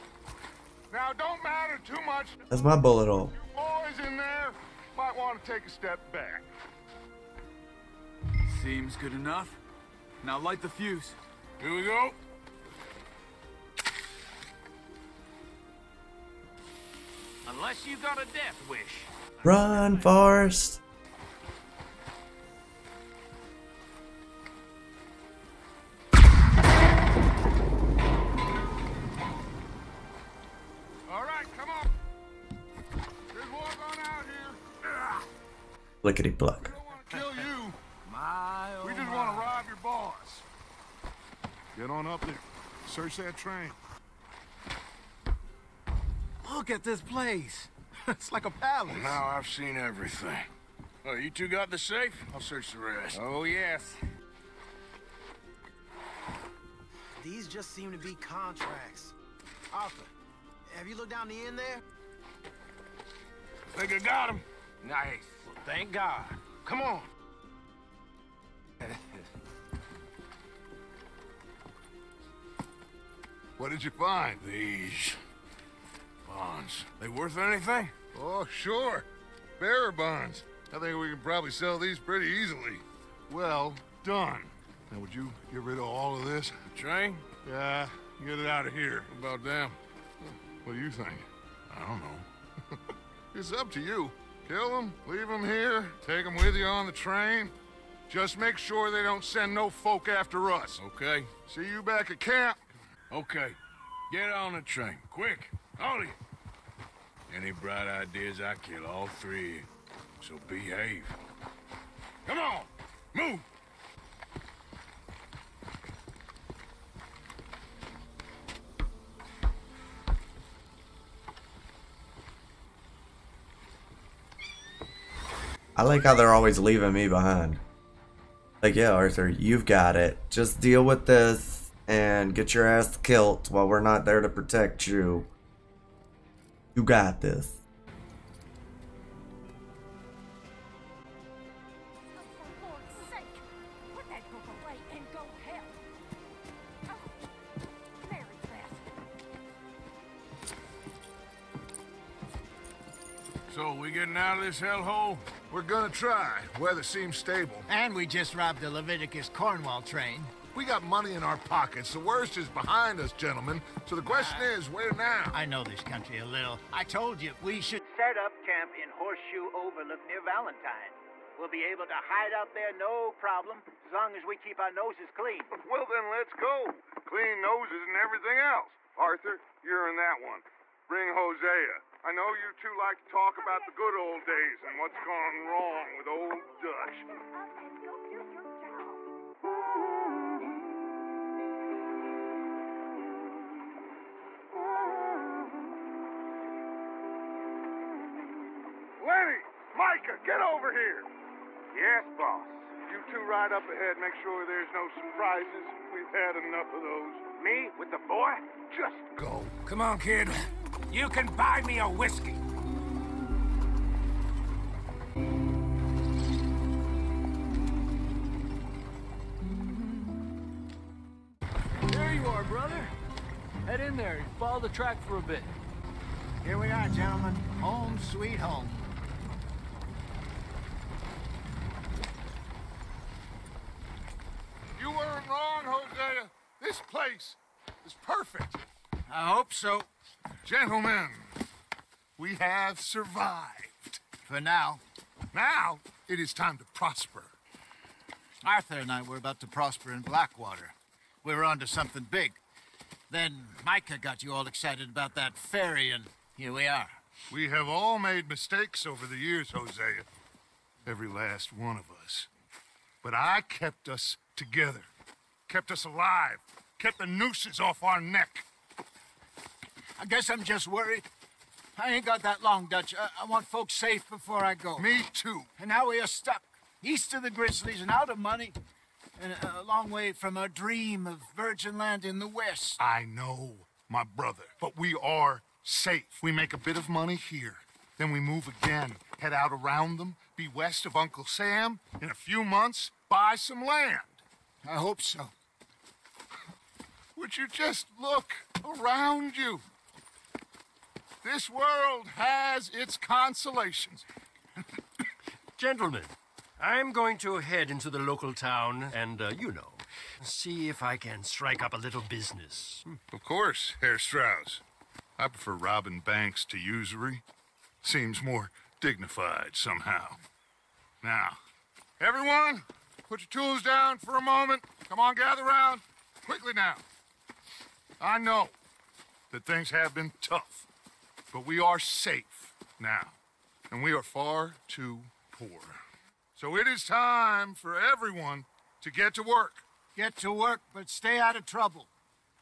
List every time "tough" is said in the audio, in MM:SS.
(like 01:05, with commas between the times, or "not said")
05:30.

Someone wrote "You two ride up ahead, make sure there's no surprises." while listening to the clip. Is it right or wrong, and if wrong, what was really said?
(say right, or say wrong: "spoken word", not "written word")
right.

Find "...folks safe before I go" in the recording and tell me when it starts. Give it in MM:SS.
04:33.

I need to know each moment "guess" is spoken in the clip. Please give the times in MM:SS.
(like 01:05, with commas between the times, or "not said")
04:30.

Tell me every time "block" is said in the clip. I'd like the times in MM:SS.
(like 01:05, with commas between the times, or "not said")
00:36.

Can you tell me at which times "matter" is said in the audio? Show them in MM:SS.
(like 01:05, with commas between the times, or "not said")
00:01.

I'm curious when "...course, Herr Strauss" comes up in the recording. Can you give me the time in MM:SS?
05:13.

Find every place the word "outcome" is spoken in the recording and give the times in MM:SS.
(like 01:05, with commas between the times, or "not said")
not said.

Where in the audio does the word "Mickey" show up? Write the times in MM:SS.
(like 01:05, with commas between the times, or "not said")
not said.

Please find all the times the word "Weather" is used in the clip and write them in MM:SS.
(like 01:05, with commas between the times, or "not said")
02:36.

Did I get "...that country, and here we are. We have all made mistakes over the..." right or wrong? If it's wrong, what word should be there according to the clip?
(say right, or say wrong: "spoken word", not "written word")
wrong: "ferry", not "country".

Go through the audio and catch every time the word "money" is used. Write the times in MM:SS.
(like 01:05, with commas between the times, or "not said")
02:40, 04:38, 04:46.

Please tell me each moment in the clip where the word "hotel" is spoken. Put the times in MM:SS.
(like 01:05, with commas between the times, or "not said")
not said.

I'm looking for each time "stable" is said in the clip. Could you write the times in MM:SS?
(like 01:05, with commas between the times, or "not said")
02:37.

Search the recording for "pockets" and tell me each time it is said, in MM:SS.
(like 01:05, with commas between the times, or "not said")
02:41.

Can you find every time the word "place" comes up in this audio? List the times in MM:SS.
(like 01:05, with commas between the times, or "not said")
00:46, 03:56.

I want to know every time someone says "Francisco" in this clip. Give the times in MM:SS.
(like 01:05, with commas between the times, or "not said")
not said.